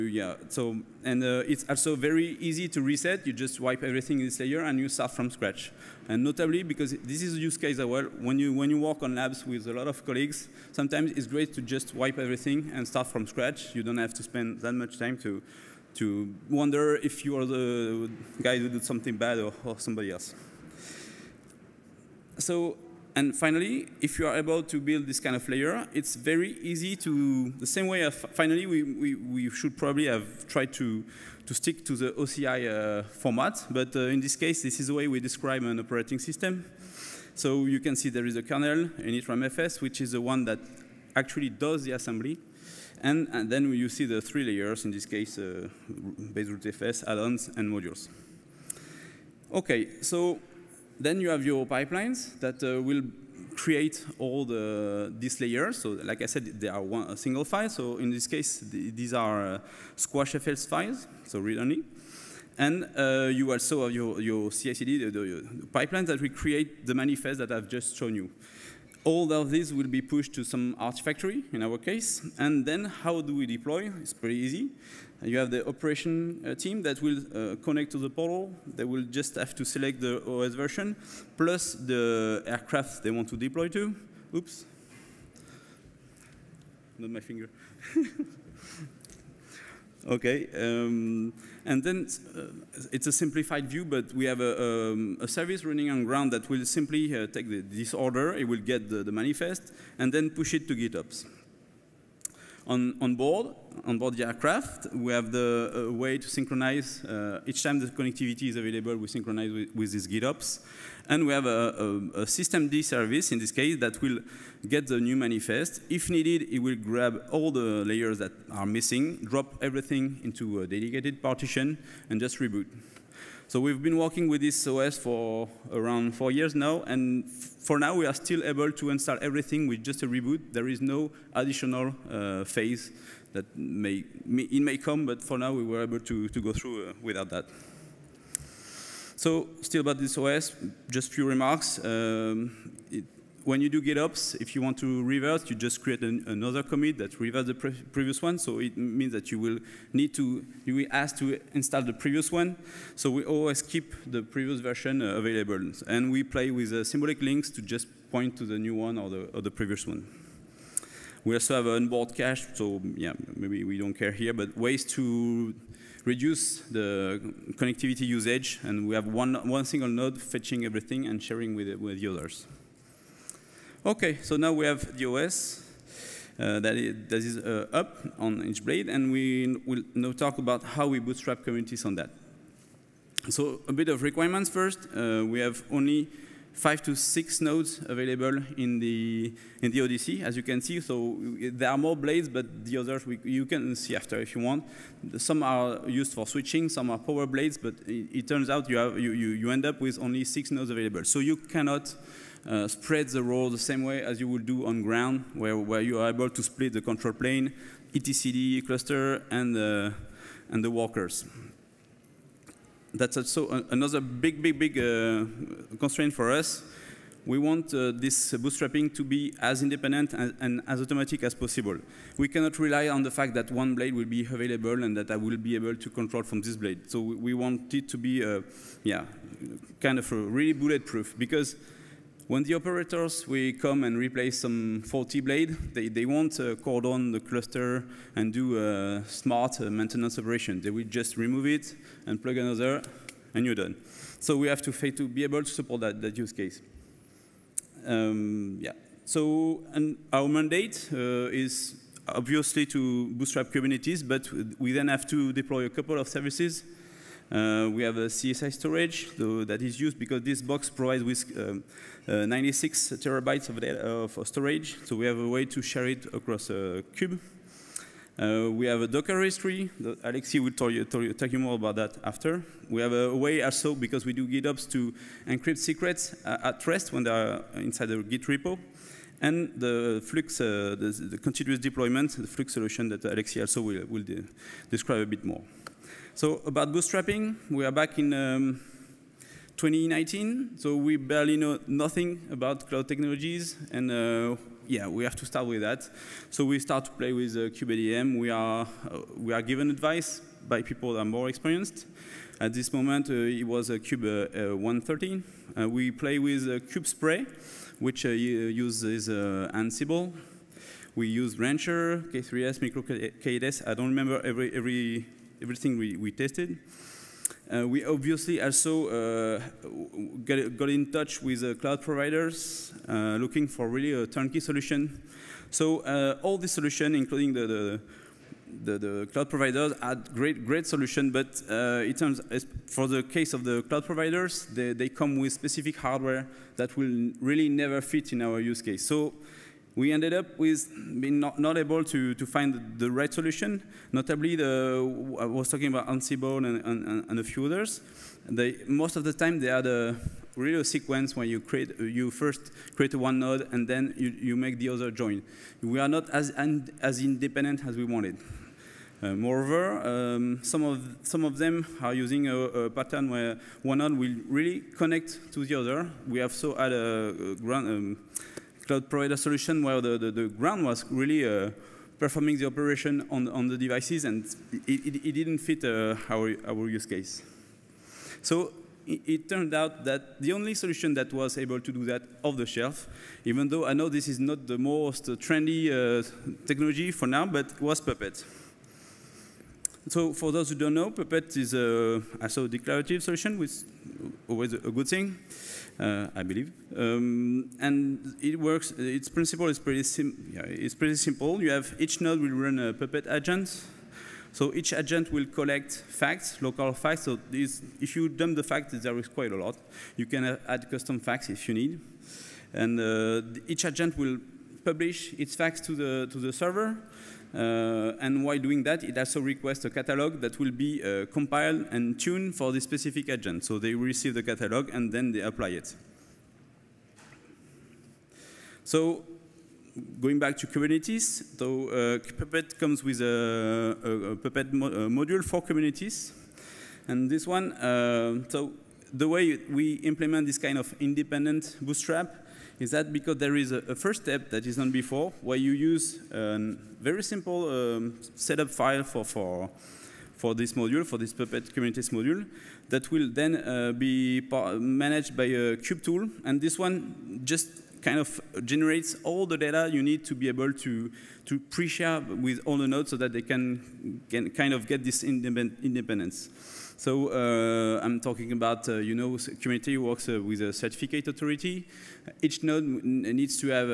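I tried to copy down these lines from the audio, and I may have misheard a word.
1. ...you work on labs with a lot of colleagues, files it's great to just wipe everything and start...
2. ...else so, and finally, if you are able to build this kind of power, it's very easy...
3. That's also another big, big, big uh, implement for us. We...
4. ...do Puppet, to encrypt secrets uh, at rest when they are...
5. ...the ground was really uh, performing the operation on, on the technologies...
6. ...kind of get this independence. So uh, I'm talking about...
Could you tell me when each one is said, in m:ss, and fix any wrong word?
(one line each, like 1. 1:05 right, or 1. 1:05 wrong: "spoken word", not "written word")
1. 0:08 wrong: "sometimes", not "files"
2. 0:20 wrong: "layer", not "power"
3. 3:32 wrong: "constraint", not "implement"
4. 4:34 wrong: "GitOps", not "Puppet"
5. 6:10 wrong: "devices", not "technologies"
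6. 7:44 right.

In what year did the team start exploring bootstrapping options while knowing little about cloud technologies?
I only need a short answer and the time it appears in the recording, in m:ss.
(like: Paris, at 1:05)
2019, at 4:49.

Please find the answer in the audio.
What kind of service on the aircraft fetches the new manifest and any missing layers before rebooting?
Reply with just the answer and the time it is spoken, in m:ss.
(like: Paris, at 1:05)
systemd service, at 1:52.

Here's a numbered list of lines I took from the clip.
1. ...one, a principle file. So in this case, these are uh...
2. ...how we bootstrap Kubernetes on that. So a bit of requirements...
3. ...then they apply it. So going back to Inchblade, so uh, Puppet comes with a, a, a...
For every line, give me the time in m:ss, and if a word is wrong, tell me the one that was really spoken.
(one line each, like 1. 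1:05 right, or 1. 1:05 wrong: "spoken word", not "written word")
1. 0:56 wrong: "single", not "principle"
2. 3:00 right
3. 7:04 wrong: "Kubernetes", not "Inchblade".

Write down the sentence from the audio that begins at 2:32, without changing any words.
So we always keep the previous version uh, available.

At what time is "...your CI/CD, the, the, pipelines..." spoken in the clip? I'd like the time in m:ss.
1:04.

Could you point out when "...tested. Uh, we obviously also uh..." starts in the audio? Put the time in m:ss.
5:16.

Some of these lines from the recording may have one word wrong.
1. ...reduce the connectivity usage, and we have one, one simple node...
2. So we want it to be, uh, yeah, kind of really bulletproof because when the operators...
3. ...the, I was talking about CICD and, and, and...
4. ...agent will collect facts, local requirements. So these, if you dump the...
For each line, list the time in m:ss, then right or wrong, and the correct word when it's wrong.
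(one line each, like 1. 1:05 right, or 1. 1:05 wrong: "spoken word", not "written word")
1. 2:46 wrong: "single", not "simple"
2. 3:46 right
3. 5:44 wrong: "Ansible", not "CICD"
4. 6:44 wrong: "facts", not "requirements".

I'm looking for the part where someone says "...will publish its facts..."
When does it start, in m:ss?
6:53.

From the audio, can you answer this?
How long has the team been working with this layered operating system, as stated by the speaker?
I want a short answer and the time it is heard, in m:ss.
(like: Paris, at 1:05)
4 years, at 2:06.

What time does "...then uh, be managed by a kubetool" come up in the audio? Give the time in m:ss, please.
7:33.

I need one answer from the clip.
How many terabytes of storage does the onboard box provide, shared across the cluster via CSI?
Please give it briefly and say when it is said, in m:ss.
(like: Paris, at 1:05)
96, at 4:22.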